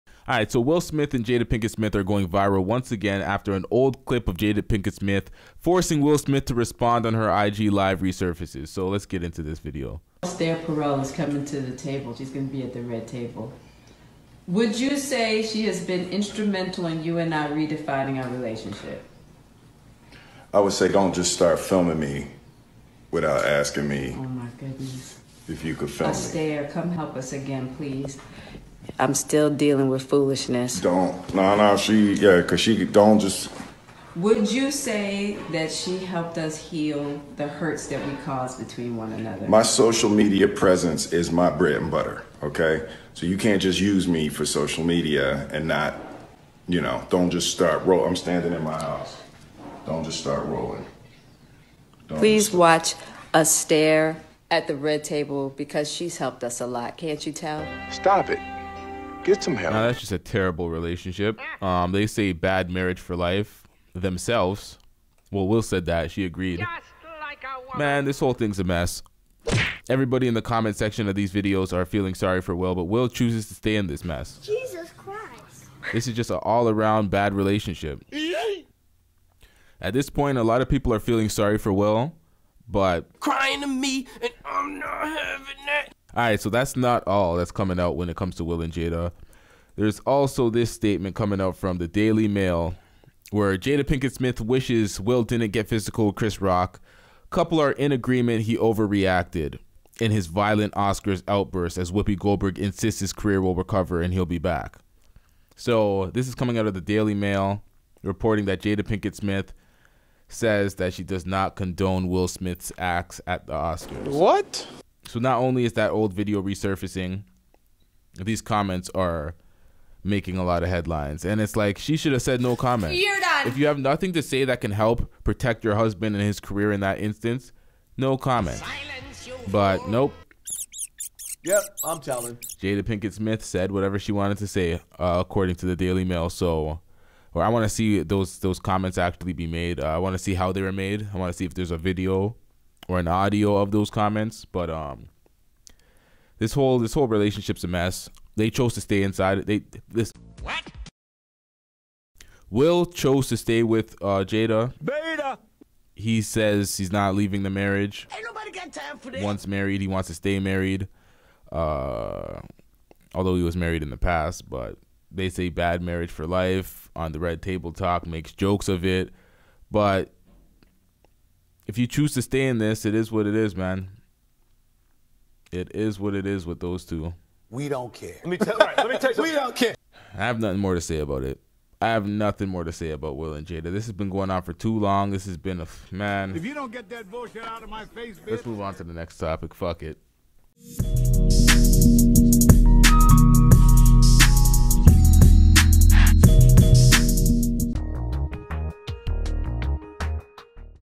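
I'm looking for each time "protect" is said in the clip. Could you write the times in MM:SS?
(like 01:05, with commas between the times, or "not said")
02:05.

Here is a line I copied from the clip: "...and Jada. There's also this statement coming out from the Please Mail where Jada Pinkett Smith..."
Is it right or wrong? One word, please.
wrong.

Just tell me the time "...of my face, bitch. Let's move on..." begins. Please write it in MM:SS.
03:07.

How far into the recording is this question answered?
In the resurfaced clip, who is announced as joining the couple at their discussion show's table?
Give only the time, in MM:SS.
00:10.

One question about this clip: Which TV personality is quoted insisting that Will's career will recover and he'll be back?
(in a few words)
Whoopi Goldberg.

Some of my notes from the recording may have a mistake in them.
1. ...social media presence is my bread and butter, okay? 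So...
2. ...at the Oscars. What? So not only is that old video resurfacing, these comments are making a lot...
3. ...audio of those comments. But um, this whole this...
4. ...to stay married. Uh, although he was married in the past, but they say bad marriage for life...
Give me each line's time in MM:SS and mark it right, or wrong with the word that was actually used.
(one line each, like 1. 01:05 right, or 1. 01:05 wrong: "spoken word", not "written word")
1. 00:39 right
2. 01:53 right
3. 02:23 right
4. 02:40 right.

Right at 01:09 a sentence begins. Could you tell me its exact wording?
Everybody in the comment section of these videos are feeling sorry for Will, but Will chooses to stay in this mess.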